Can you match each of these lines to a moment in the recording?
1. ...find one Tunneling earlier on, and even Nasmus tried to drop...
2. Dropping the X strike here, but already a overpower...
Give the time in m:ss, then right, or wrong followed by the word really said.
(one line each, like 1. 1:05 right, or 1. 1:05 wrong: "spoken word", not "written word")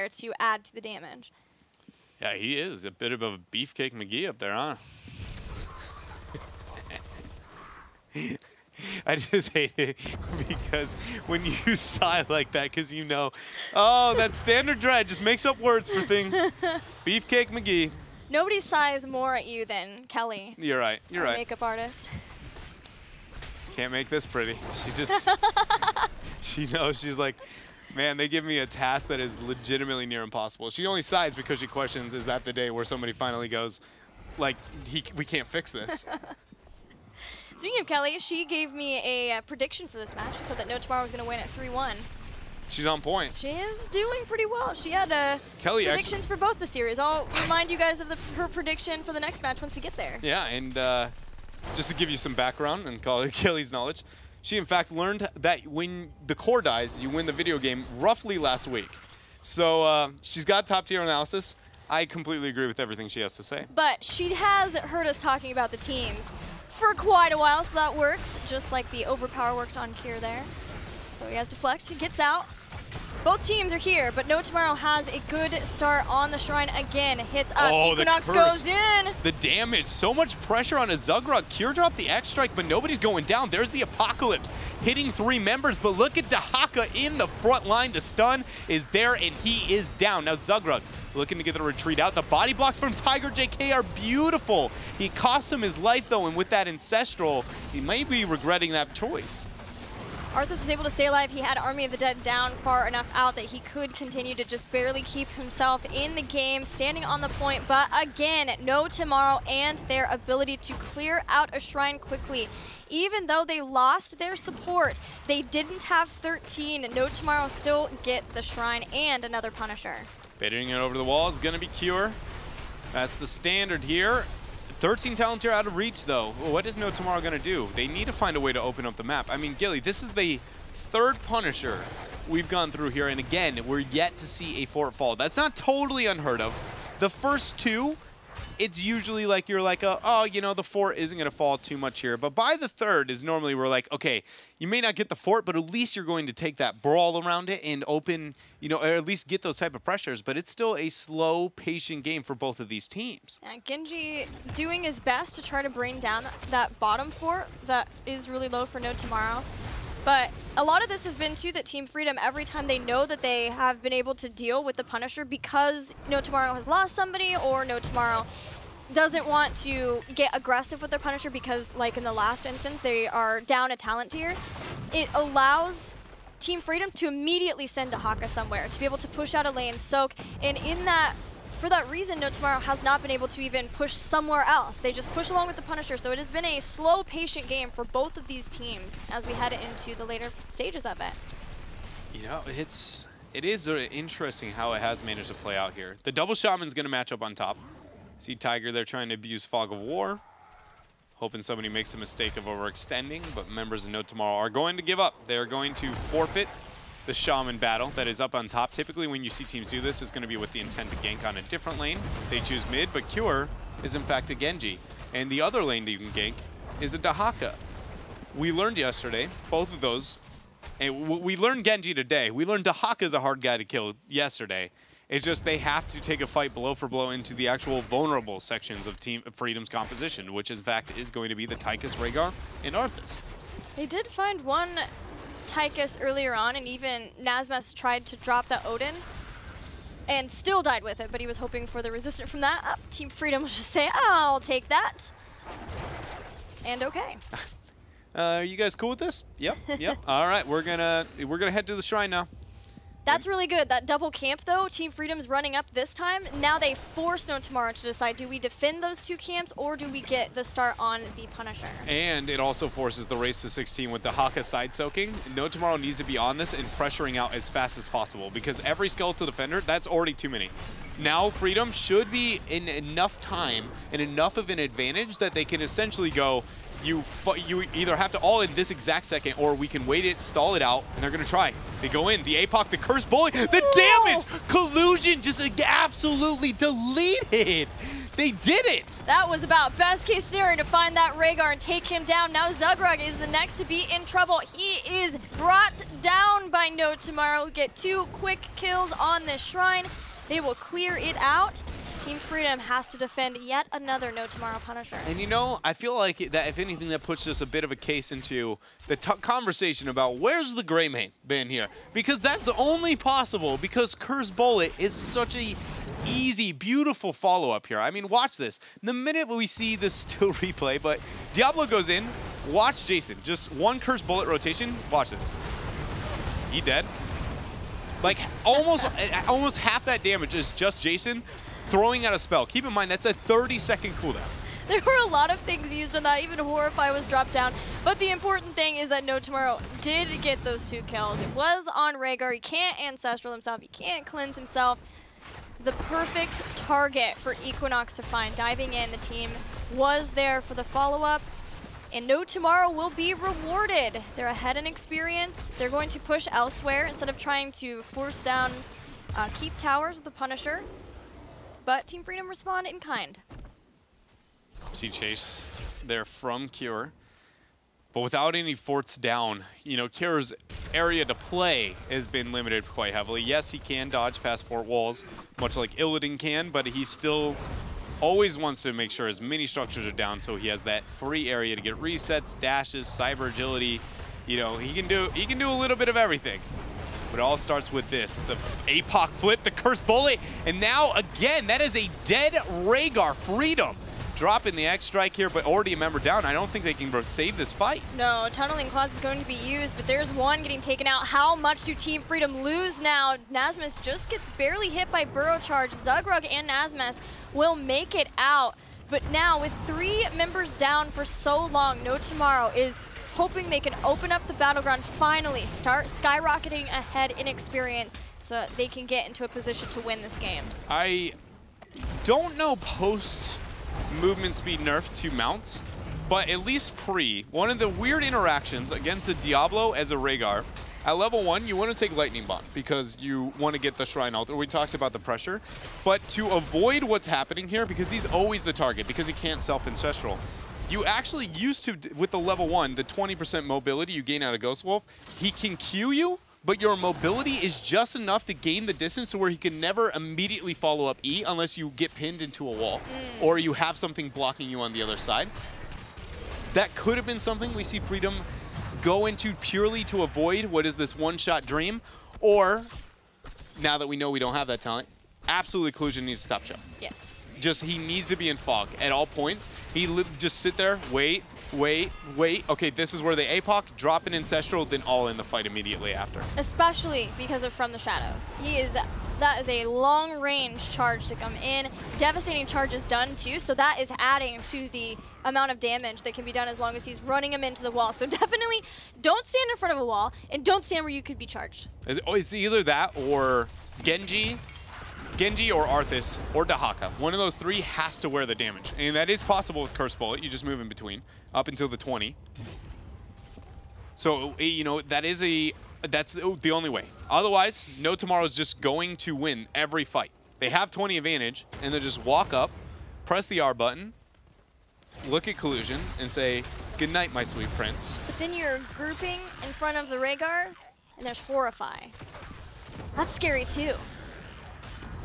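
1. 3:54 wrong: "Tychus", not "Tunneling"
2. 6:34 wrong: "member", not "overpower".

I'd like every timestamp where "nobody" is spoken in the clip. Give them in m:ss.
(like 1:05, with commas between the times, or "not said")
0:18, 1:22.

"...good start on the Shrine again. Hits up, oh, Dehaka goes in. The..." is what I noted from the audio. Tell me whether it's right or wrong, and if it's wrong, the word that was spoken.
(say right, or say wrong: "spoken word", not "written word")
wrong: "Equinox", not "Dehaka".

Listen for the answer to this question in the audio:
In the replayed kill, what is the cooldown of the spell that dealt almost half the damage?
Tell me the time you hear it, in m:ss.
5:33.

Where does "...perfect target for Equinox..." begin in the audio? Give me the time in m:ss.
5:45.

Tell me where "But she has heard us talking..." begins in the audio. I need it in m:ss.
1:03.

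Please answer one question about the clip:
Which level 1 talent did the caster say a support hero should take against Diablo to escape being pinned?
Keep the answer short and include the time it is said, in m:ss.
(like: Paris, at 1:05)
Lightning Bond, at 7:11.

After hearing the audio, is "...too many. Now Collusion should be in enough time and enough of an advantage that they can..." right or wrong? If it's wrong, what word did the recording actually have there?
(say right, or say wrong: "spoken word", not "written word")
wrong: "Freedom", not "Collusion".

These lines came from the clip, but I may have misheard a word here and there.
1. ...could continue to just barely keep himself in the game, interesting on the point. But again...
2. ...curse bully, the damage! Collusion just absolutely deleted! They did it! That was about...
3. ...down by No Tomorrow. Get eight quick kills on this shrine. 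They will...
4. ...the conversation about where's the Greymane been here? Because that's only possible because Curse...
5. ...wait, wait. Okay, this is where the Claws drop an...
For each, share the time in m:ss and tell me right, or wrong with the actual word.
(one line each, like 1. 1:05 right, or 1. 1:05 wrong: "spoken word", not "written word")
1. 1:43 wrong: "standing", not "interesting"
2. 4:42 right
3. 4:56 wrong: "two", not "eight"
4. 5:08 right
5. 7:51 wrong: "APOC", not "Claws".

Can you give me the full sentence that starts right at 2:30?
But it's still a slow, patient game for both of these teams.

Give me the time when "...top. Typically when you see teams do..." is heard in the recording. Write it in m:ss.
3:28.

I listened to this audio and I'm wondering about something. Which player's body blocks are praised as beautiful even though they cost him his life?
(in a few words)
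Tiger JK.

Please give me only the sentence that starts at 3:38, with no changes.
We learned yesterday, both of those, and we learned Genji today.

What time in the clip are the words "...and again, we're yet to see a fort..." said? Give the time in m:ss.
2:13.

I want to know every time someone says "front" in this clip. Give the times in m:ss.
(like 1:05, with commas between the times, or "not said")
1:27, 8:09, 8:39.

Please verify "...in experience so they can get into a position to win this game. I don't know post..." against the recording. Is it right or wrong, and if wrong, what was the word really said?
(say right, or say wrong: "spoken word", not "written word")
right.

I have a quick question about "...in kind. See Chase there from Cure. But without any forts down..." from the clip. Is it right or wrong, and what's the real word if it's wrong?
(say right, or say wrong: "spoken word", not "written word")
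right.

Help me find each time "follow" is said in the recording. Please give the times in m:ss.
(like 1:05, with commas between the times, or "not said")
5:17, 5:50, 7:30.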